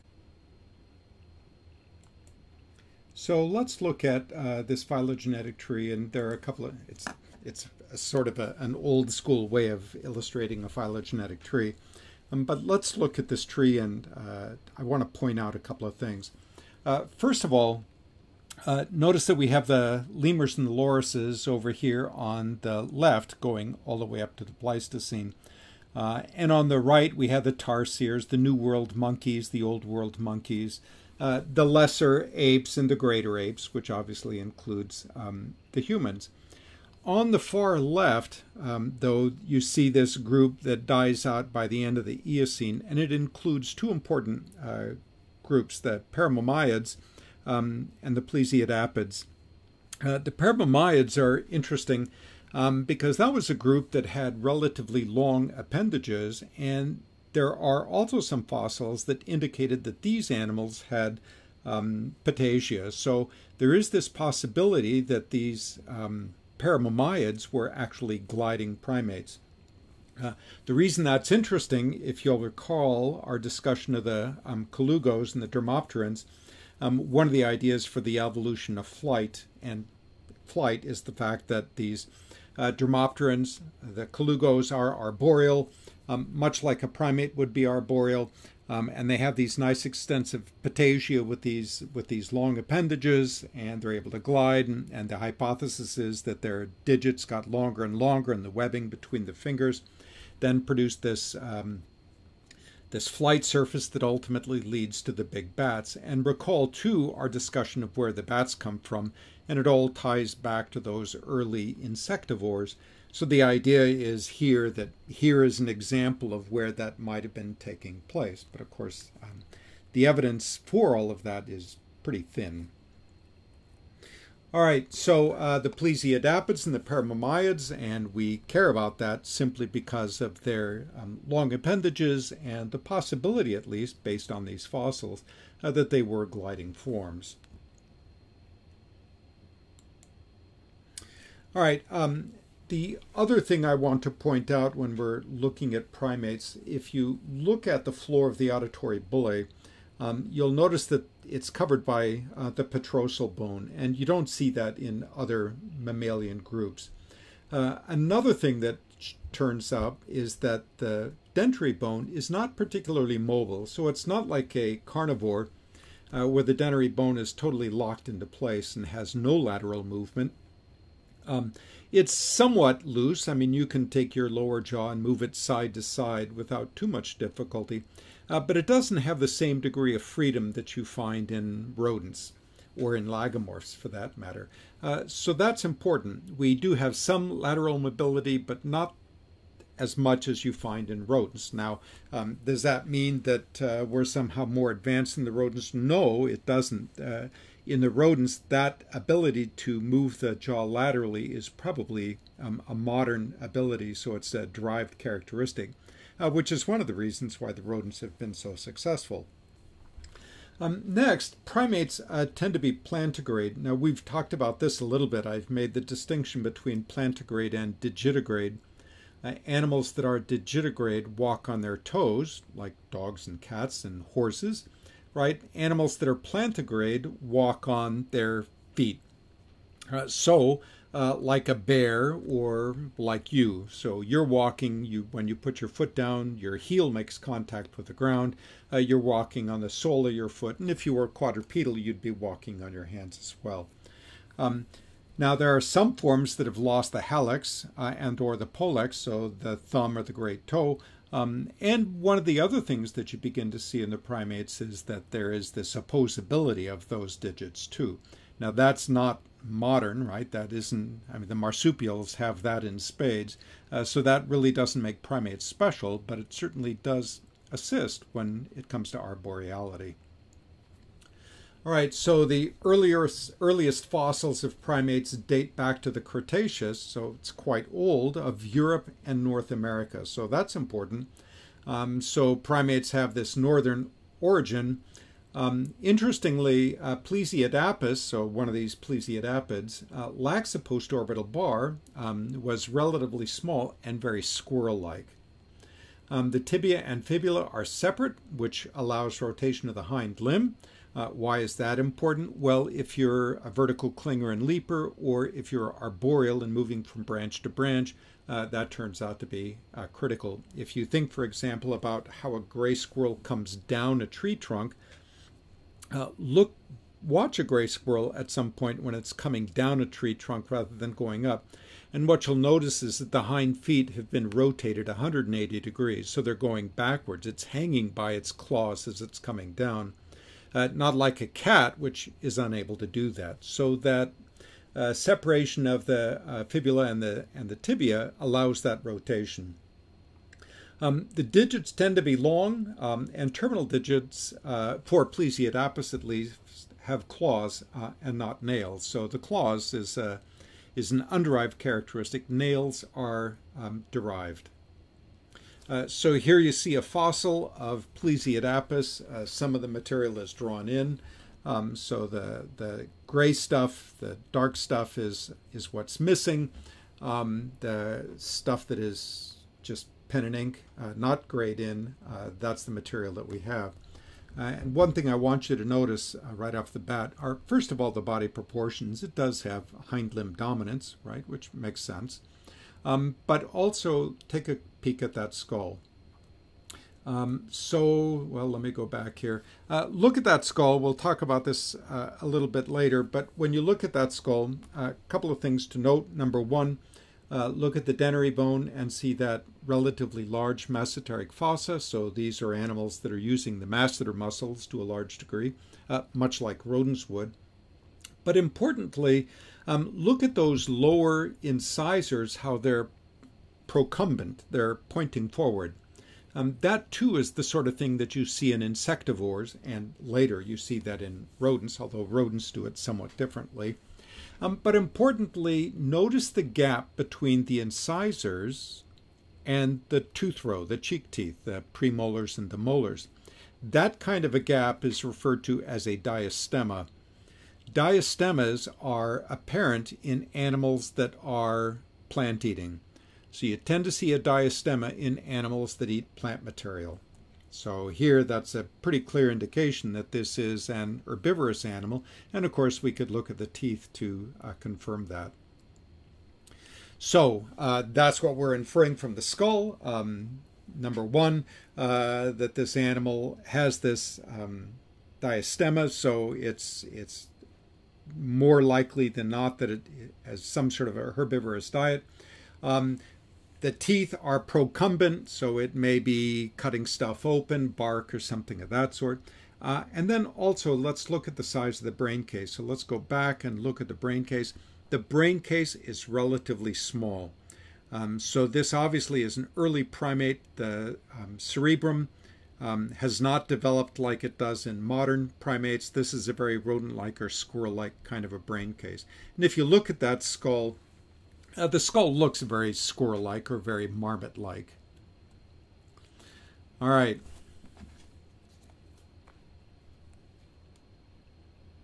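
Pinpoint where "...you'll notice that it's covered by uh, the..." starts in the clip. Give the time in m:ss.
2:30.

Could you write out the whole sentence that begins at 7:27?
So here that's a pretty clear indication that this is an herbivorous animal.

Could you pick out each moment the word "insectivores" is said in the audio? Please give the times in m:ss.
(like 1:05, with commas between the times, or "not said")
1:51, 6:58.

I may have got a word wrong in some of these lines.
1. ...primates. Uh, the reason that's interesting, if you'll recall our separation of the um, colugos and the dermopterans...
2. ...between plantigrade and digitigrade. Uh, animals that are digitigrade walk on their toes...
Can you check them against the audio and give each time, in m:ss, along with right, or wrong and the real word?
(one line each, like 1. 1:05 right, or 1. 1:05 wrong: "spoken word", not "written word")
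1. 1:08 wrong: "discussion", not "separation"
2. 3:36 right.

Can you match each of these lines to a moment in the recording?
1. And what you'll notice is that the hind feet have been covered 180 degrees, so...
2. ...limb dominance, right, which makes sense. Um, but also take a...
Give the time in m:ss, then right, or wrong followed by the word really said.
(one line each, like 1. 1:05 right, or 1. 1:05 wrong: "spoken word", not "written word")
1. 5:21 wrong: "rotated", not "covered"
2. 6:20 right.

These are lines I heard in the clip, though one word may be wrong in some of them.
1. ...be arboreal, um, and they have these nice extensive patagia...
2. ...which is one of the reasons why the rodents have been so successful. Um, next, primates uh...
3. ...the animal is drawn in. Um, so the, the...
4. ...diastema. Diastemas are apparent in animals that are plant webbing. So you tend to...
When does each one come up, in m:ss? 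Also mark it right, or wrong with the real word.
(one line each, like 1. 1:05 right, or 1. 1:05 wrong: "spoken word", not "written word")
1. 1:27 right
2. 3:26 right
3. 5:59 wrong: "material", not "animal"
4. 7:15 wrong: "eating", not "webbing".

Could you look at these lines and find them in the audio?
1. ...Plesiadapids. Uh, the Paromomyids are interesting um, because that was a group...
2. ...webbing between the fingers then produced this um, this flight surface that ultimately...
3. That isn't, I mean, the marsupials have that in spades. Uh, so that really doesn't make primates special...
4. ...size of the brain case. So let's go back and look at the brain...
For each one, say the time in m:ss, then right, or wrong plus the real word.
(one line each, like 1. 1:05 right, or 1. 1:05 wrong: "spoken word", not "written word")
1. 0:48 right
2. 1:38 right
3. 4:20 right
4. 8:01 right.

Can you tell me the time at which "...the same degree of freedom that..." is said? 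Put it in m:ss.
2:59.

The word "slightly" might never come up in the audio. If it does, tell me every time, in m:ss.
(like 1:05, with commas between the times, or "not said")
not said.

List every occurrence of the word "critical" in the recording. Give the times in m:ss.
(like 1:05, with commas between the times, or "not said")
5:09.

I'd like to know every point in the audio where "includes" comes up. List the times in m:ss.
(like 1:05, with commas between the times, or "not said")
0:34, 0:43.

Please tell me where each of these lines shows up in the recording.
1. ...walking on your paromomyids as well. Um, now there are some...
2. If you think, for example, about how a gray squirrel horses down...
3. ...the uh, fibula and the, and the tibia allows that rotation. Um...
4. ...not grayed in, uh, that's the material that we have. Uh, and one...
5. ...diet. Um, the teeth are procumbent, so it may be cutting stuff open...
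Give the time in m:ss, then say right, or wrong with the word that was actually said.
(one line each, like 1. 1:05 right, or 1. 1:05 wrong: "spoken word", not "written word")
1. 4:02 wrong: "hands", not "paromomyids"
2. 5:10 wrong: "comes", not "horses"
3. 5:35 right
4. 6:10 right
5. 7:51 right.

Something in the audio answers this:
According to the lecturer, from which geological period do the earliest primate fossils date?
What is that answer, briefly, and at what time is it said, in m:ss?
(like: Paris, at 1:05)
Cretaceous, at 4:36.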